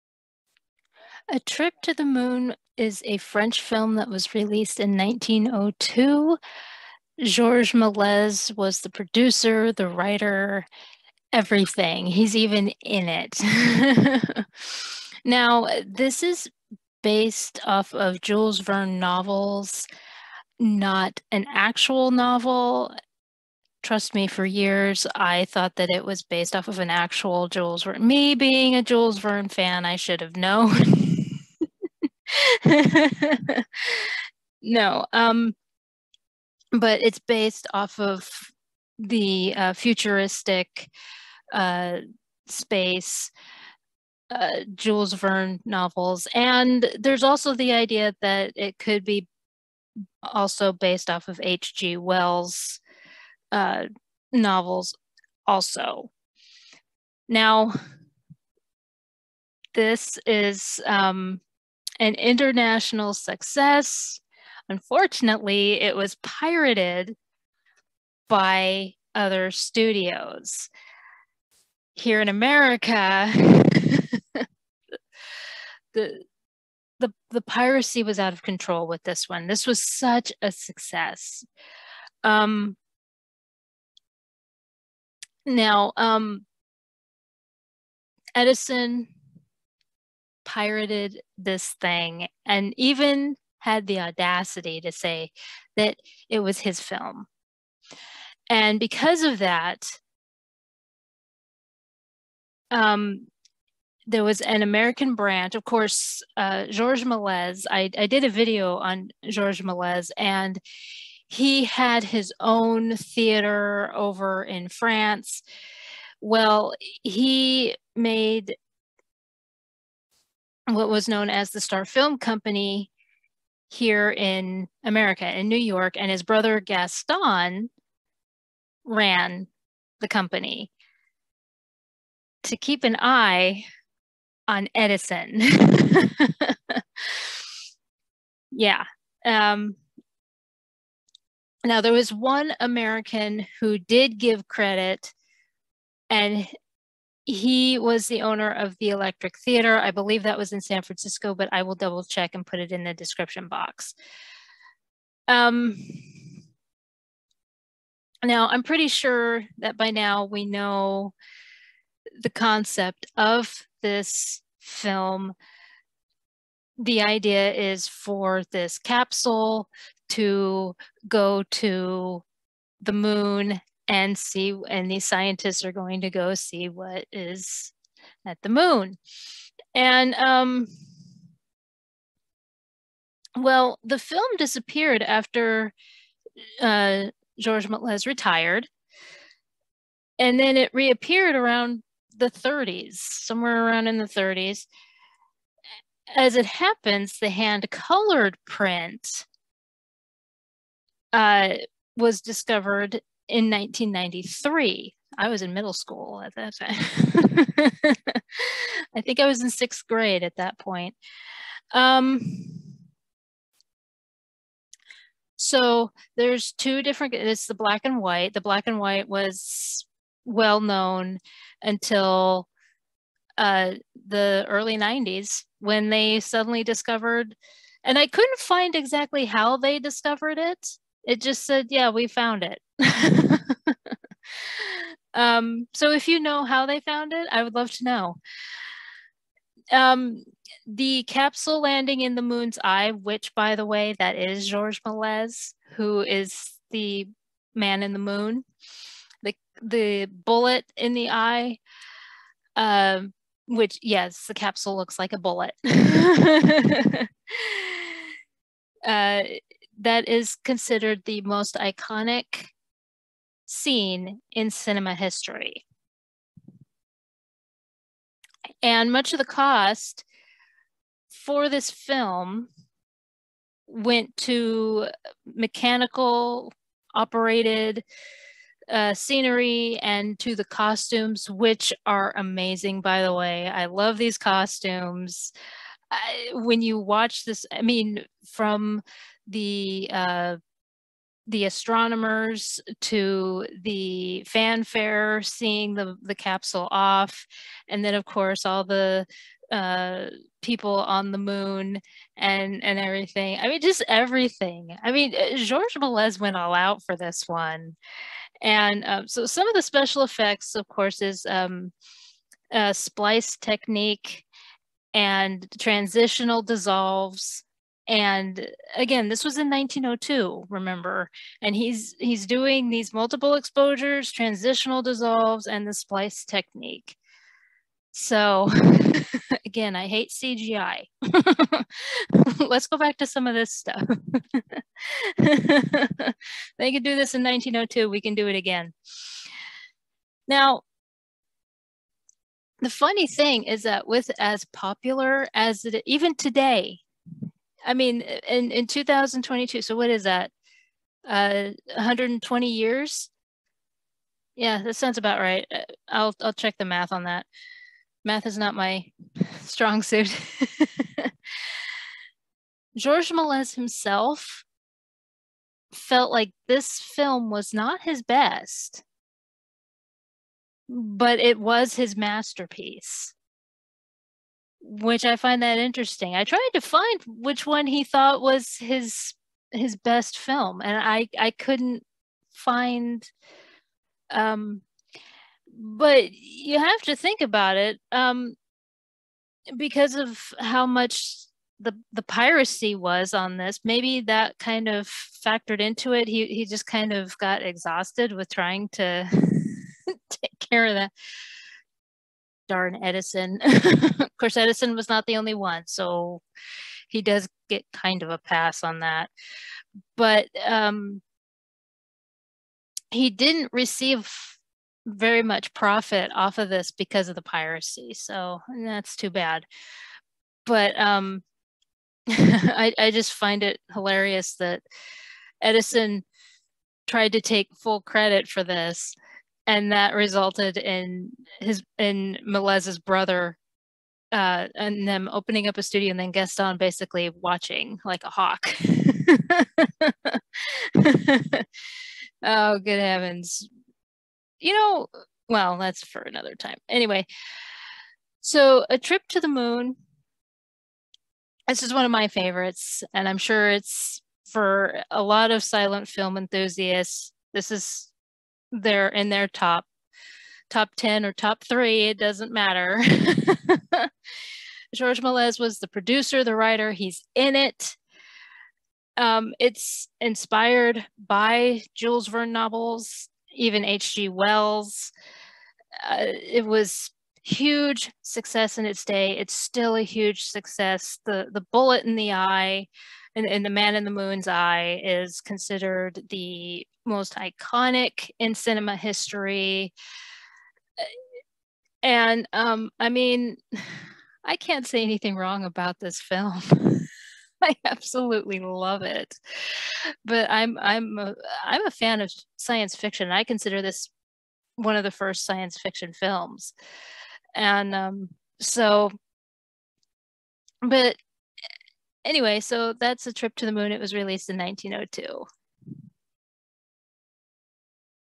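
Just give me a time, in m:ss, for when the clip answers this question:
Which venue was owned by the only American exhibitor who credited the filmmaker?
2:28.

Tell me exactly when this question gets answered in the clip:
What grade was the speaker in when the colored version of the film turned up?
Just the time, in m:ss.
3:29.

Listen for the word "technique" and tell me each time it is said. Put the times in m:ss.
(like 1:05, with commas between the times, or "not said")
5:13, 5:26.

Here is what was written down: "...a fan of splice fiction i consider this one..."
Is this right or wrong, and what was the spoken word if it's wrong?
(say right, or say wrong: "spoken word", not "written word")
wrong: "science", not "splice".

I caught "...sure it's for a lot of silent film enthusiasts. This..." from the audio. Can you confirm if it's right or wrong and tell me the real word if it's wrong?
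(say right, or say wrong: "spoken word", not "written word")
right.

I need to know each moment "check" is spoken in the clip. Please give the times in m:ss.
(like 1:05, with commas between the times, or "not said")
2:32, 5:56.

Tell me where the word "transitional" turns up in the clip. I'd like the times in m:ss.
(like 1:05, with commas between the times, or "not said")
5:15, 5:24.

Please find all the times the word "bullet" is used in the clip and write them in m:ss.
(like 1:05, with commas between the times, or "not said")
4:10, 4:15, 8:01.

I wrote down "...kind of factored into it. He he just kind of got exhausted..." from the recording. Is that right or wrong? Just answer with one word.
right.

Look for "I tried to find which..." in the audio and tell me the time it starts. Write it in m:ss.
6:16.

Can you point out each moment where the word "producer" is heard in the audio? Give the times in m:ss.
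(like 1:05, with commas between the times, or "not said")
0:08, 7:45.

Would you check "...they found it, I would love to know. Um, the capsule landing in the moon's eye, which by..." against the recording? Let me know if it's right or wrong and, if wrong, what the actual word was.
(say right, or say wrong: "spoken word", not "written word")
right.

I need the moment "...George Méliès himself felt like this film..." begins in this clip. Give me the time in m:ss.
6:02.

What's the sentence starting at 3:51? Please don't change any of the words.
It just said, yeah, we found it.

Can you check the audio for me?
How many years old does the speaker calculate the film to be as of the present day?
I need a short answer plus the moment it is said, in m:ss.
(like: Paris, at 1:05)
120, at 5:51.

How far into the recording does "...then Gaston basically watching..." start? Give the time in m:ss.
7:15.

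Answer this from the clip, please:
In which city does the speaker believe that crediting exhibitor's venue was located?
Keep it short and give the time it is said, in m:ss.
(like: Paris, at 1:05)
San Francisco, at 2:30.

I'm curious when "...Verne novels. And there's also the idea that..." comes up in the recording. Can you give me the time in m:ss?
0:45.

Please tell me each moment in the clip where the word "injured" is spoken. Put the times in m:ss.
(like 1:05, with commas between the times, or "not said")
not said.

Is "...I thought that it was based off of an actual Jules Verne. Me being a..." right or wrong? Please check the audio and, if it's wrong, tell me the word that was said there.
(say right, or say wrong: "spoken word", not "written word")
right.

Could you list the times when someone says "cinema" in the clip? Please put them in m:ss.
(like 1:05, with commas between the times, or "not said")
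4:24, 8:08.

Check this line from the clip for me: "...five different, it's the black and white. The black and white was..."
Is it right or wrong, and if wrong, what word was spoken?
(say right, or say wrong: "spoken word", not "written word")
wrong: "two", not "five".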